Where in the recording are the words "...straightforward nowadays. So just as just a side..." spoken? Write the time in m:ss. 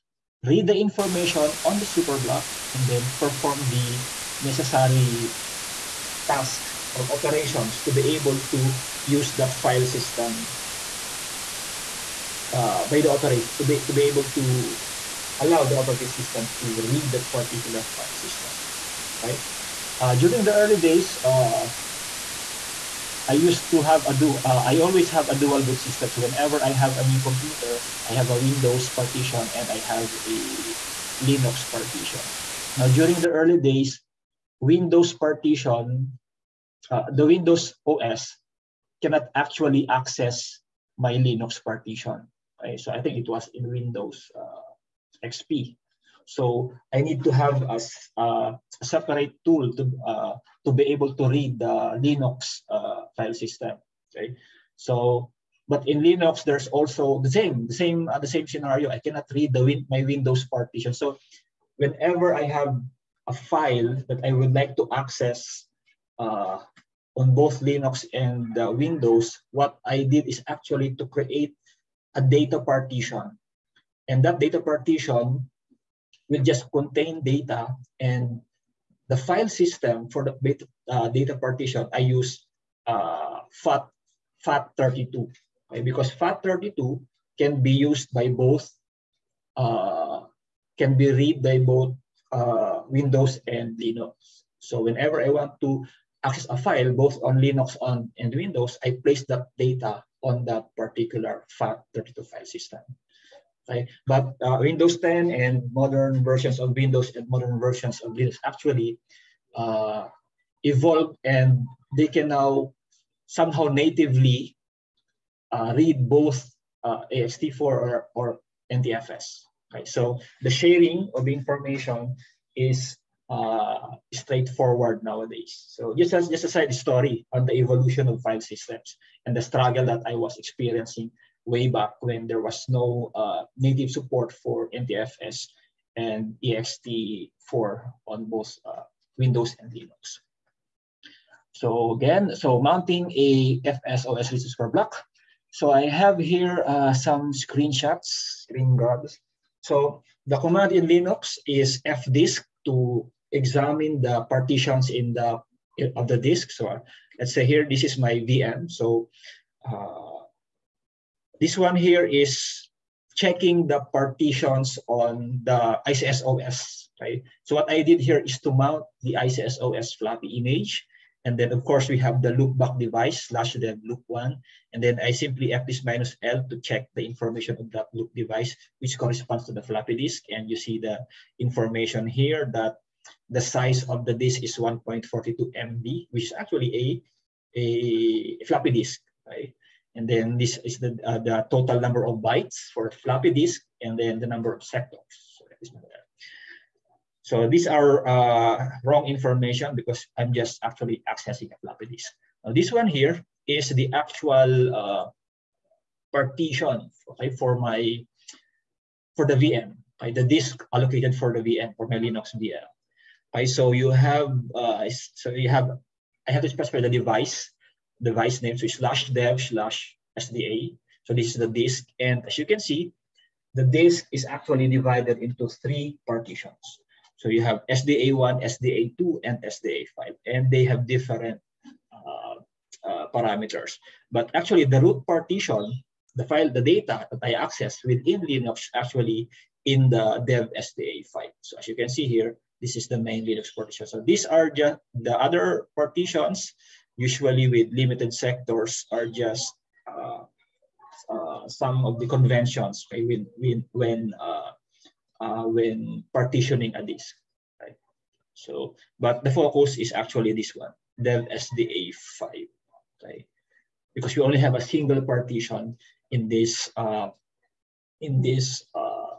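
2:04.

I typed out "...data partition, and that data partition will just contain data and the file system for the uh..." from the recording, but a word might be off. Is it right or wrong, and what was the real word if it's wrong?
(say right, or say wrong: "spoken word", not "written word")
right.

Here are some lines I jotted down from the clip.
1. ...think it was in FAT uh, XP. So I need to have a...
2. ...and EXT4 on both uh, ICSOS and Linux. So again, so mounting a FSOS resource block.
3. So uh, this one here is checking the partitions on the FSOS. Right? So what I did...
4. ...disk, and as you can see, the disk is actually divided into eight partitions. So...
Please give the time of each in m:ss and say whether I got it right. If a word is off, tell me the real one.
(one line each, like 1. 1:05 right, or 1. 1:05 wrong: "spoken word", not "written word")
1. 0:43 wrong: "Windows", not "FAT"
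2. 2:15 wrong: "Windows", not "ICSOS"
3. 2:38 wrong: "ICSOS", not "FSOS"
4. 3:41 wrong: "three", not "eight".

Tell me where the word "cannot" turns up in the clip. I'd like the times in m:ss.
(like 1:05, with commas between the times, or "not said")
0:38, 0:58.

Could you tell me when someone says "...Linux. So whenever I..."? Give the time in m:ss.
1:33.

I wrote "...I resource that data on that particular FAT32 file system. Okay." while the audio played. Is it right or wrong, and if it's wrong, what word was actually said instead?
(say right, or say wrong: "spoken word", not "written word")
wrong: "place", not "resource".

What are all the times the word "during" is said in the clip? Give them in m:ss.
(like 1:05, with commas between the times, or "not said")
0:20, 0:32.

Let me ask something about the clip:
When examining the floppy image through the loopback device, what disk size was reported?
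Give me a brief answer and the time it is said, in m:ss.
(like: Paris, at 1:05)
1.42 MB, at 3:04.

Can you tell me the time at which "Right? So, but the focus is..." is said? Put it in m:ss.
4:17.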